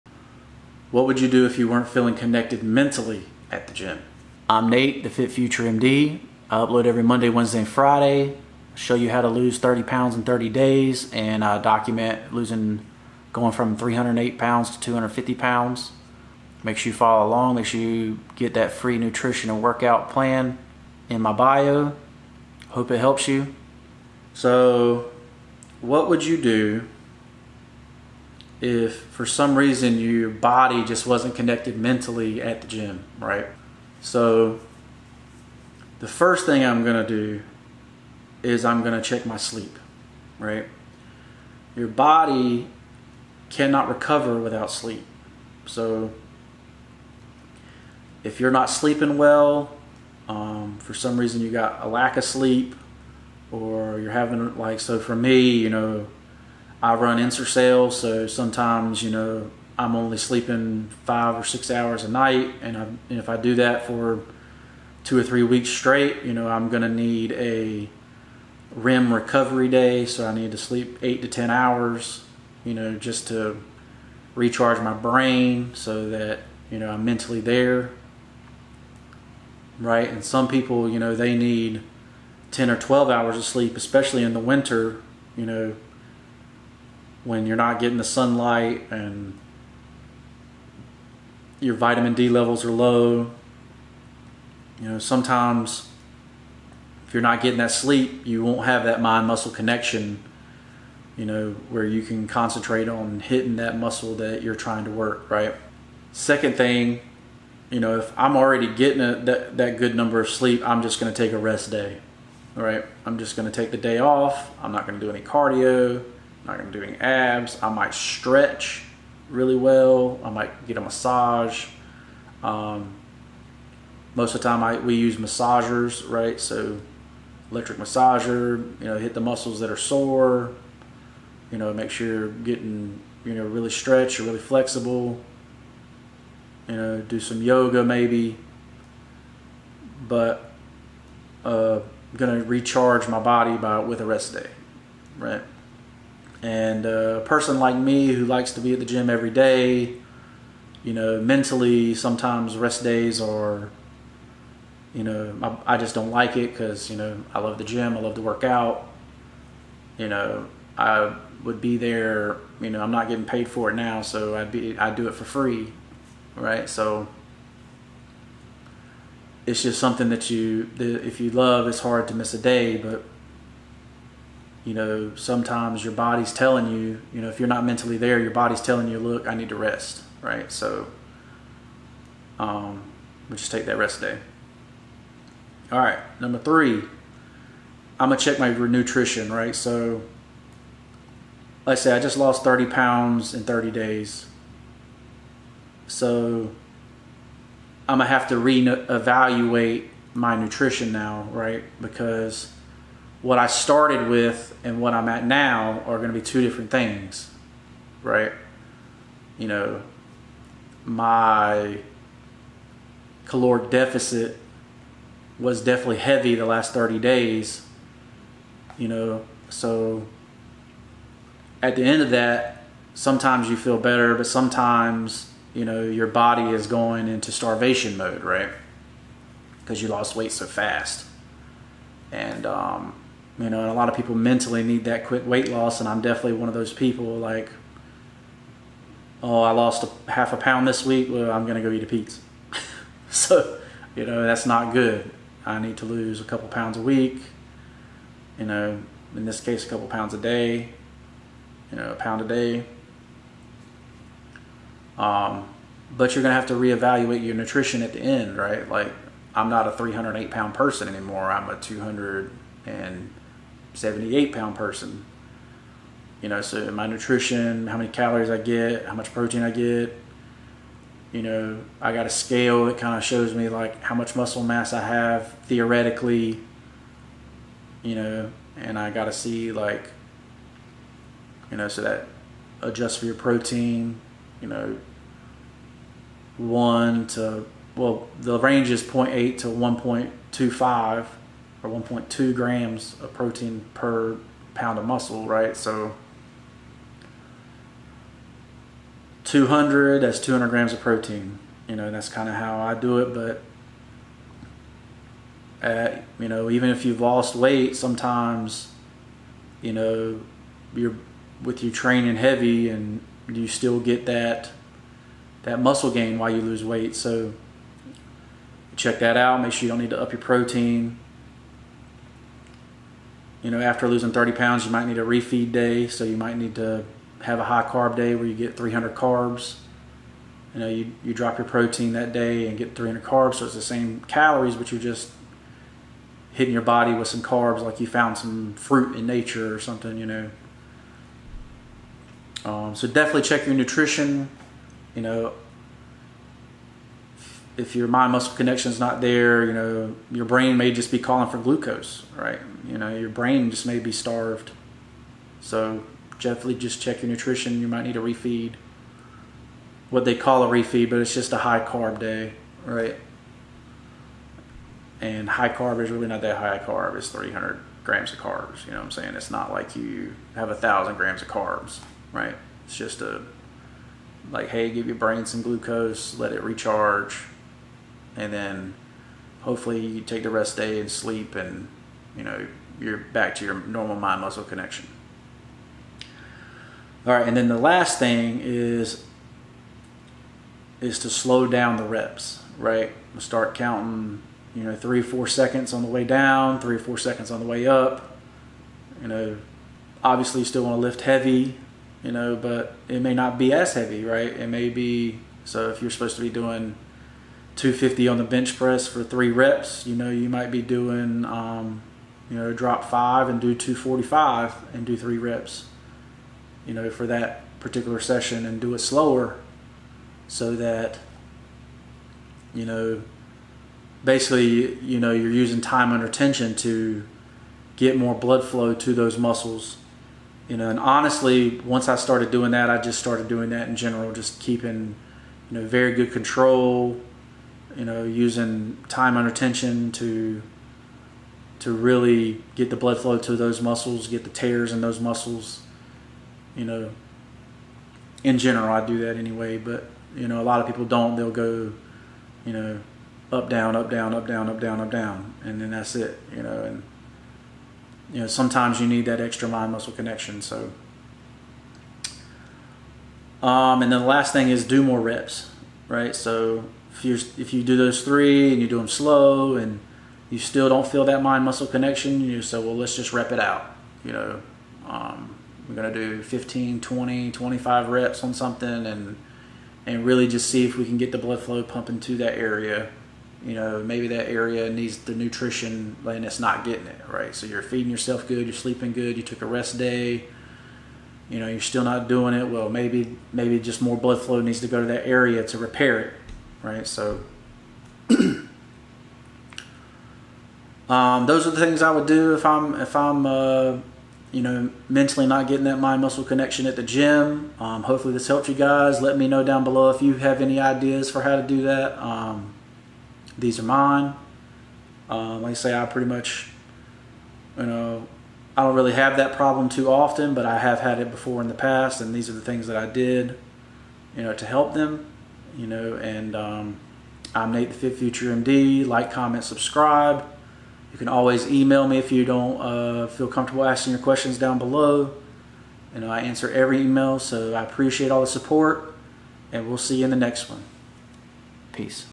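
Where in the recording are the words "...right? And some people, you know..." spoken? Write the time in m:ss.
1:19.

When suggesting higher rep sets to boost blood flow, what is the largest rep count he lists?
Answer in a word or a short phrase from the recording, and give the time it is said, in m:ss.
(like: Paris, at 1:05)
25, at 7:57.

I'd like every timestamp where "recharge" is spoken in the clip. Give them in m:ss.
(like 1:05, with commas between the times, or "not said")
1:14, 2:22, 6:16.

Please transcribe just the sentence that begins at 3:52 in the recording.
And, um, you know, and a lot of people mentally need that quick weight loss, and I'm definitely one of those people.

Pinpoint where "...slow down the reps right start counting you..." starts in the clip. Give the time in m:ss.
6:31.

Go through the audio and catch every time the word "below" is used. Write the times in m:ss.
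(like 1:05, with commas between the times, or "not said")
8:29, 8:54.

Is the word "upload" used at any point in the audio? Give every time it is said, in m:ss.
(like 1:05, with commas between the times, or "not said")
0:06.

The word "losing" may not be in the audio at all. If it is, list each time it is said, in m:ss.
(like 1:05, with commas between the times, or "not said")
0:12, 5:23.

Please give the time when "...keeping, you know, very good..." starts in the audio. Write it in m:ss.
7:14.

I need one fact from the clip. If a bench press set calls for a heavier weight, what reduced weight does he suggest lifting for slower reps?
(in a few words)
245.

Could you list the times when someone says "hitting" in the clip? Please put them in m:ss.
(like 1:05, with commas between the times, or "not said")
1:43, 5:36.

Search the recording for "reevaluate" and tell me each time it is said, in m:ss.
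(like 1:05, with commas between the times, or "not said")
3:18, 4:16.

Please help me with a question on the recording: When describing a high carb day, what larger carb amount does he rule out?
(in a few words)
1000 grams.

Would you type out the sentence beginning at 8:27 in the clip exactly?
Um, hopefully this helped you guys.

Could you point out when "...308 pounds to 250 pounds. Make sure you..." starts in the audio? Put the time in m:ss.
0:13.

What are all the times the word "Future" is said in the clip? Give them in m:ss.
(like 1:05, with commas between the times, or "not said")
0:05, 8:47.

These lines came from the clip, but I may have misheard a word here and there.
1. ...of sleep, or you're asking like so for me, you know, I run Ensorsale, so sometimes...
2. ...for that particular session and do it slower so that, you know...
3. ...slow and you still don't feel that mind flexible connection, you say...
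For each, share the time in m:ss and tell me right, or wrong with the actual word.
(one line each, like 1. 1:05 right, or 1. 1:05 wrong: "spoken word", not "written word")
1. 0:52 wrong: "having", not "asking"
2. 6:56 right
3. 7:48 wrong: "muscle", not "flexible".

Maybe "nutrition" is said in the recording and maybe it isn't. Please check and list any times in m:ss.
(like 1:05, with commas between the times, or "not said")
0:18, 3:08, 3:20, 4:17, 4:26, 5:43, 5:57, 8:05.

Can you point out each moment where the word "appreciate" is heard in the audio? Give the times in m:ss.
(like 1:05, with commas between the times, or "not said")
8:57.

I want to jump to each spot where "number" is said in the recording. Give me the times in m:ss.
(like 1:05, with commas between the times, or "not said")
1:49, 3:06.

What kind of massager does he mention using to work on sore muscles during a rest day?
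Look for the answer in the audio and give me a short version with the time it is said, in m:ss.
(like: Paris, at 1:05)
Electric, at 2:07.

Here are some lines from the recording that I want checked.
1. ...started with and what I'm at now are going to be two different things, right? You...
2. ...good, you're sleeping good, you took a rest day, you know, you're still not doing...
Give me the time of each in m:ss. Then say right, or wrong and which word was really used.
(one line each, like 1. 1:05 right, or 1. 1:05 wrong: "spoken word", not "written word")
1. 3:23 right
2. 8:08 right.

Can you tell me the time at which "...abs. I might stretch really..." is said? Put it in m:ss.
1:57.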